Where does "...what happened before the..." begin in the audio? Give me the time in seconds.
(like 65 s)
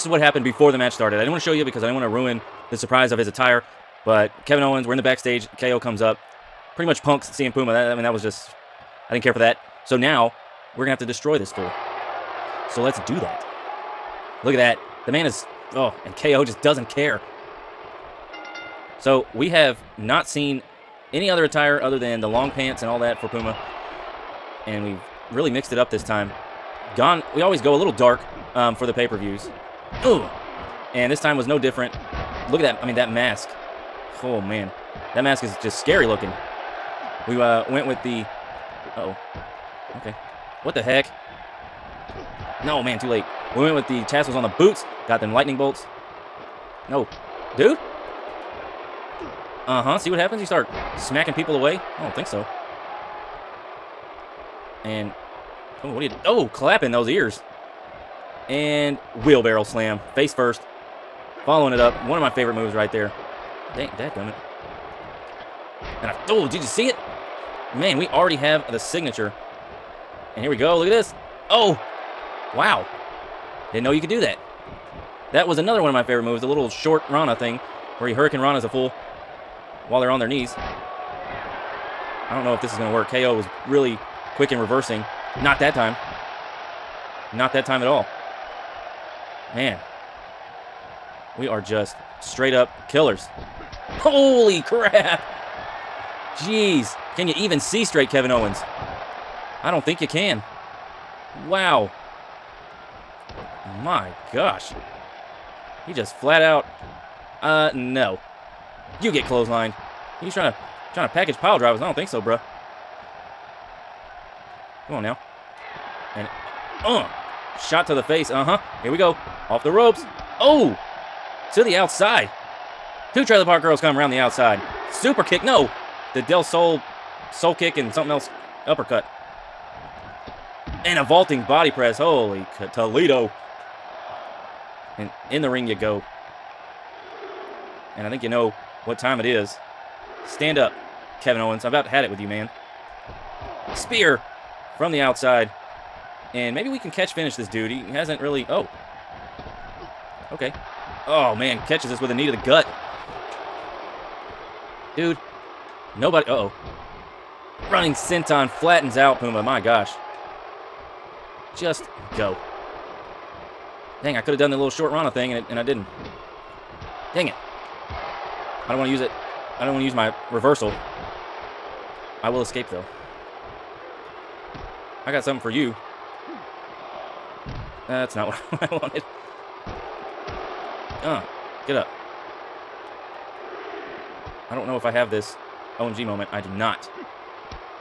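0 s.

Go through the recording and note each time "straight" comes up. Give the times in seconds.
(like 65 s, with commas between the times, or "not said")
92 s, 97 s.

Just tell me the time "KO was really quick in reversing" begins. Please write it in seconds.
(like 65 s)
83 s.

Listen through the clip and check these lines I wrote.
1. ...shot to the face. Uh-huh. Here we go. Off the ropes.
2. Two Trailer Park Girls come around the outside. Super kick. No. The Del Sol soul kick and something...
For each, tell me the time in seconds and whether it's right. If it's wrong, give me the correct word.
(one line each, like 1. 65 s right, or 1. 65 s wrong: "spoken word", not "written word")
1. 117 s right
2. 123 s right.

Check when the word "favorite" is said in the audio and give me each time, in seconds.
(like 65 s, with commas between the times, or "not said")
62 s, 76 s.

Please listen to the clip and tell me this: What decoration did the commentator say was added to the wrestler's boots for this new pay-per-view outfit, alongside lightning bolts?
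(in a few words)
Tassels.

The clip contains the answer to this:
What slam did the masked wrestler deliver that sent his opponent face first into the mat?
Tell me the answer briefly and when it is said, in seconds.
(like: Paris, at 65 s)
Wheelbarrow slam, at 59 s.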